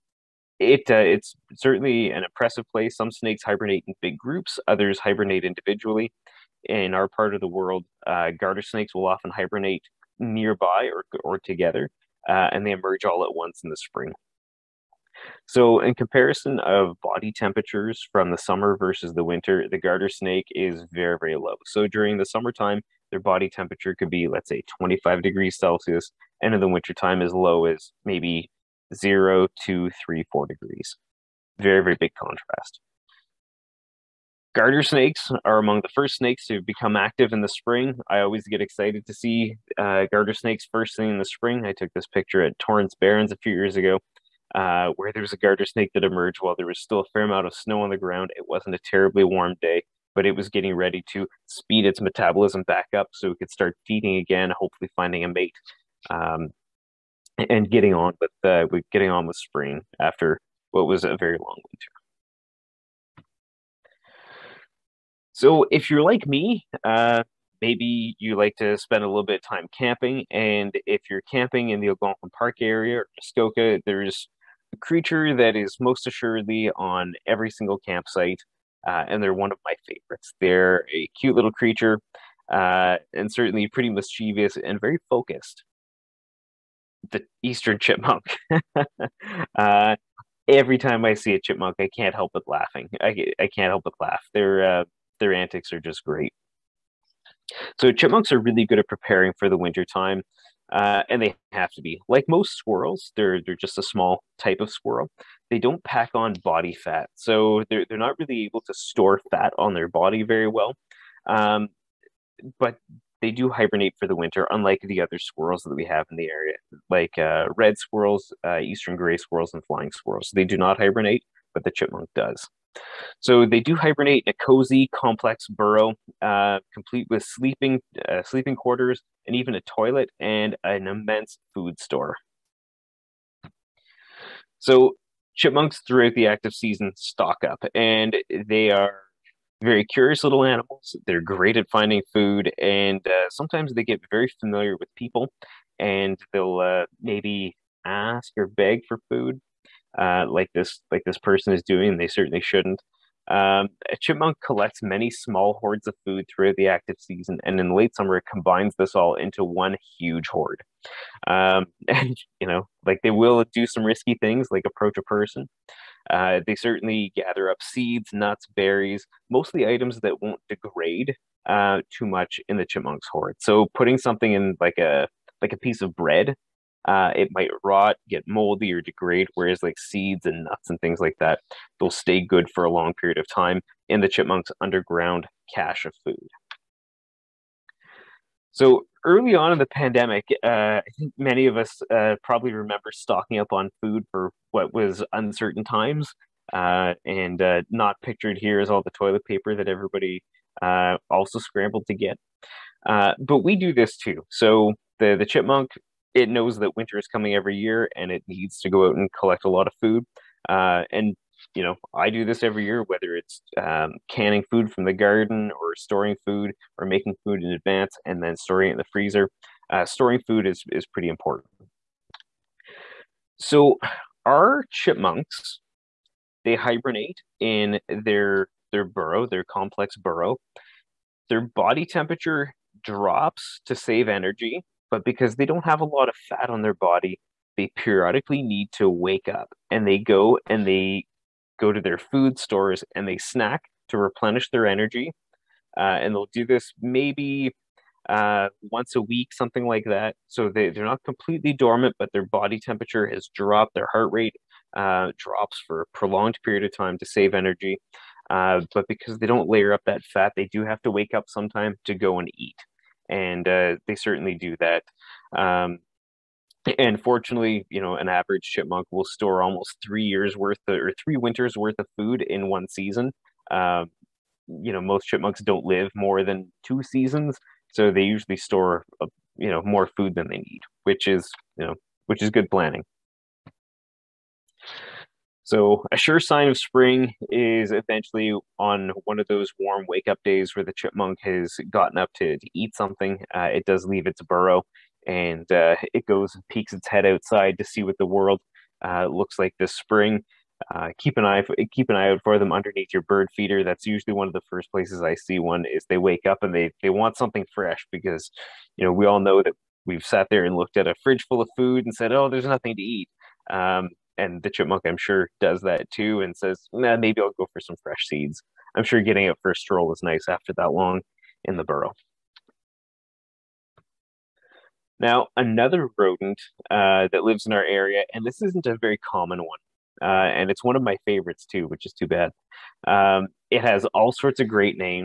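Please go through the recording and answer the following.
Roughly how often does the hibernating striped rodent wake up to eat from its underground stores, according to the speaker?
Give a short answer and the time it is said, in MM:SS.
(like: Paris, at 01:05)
once a week, at 04:08.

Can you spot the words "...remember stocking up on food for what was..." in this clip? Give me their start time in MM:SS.
03:12.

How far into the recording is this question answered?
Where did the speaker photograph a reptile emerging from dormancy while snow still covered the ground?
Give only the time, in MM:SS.
00:42.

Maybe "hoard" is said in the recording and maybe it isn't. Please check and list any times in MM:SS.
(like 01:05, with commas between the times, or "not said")
02:35, 02:40, 02:53.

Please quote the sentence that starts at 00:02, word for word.
Some snakes hibernate in big groups, others hibernate individually.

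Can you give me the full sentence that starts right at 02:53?
So putting something in like a like a piece of bread, uh, it might rot, get moldy, or degrade.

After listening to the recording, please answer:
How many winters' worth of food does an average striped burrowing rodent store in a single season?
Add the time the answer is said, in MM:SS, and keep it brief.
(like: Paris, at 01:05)
3, at 04:31.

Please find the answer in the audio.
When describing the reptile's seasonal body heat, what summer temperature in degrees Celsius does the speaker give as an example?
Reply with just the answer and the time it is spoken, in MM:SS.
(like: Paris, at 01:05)
25 degrees Celsius, at 00:24.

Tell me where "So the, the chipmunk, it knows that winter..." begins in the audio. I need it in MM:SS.
03:24.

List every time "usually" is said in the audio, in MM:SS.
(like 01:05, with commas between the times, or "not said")
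04:38, 05:03.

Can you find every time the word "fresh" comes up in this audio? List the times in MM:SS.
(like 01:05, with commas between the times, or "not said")
05:07, 05:17.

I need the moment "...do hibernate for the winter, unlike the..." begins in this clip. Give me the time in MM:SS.
01:53.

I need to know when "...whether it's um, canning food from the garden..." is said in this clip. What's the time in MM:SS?
03:32.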